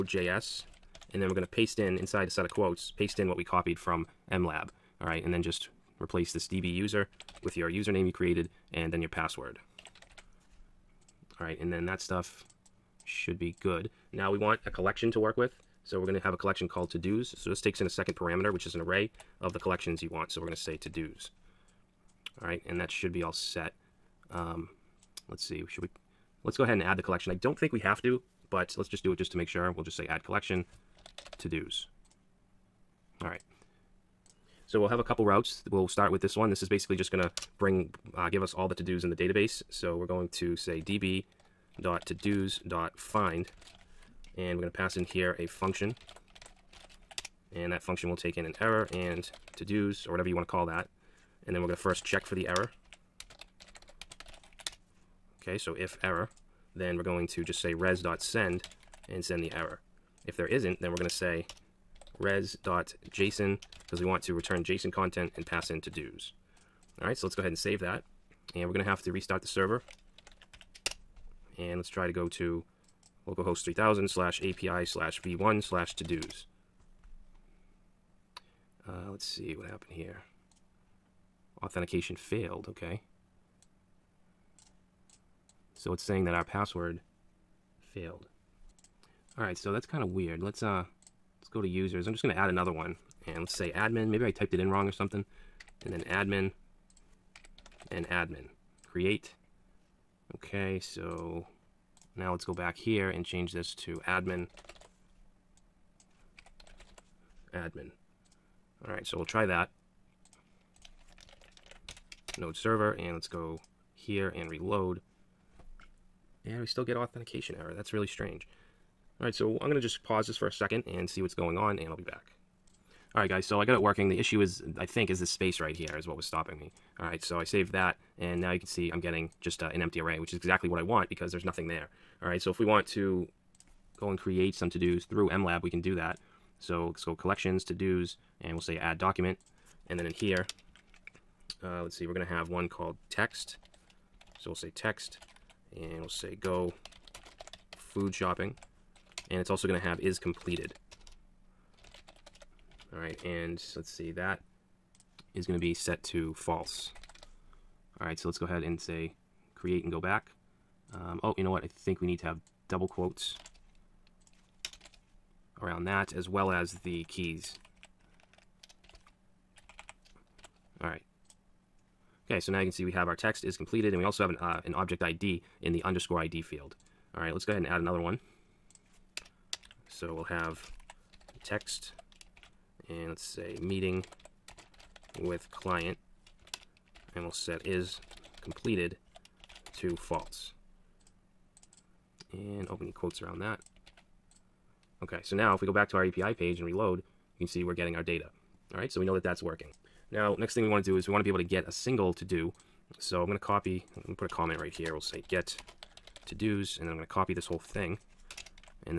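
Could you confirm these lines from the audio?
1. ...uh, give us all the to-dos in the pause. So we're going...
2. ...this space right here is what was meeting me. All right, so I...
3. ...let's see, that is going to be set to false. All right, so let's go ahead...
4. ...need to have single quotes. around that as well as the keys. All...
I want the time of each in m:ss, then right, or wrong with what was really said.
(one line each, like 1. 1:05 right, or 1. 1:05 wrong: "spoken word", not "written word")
1. 0:38 wrong: "database", not "pause"
2. 2:05 wrong: "stopping", not "meeting"
3. 2:33 right
4. 2:42 wrong: "double", not "single".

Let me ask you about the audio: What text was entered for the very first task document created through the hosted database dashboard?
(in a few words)
go food shopping.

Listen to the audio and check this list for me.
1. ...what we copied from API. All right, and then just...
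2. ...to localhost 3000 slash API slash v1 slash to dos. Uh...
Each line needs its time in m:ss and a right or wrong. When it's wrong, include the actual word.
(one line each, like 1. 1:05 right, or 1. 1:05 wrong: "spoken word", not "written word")
1. 0:03 wrong: "MLab", not "API"
2. 1:12 right.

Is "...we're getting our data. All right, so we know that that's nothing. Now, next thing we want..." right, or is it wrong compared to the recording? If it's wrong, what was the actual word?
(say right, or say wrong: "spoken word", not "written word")
wrong: "working", not "nothing".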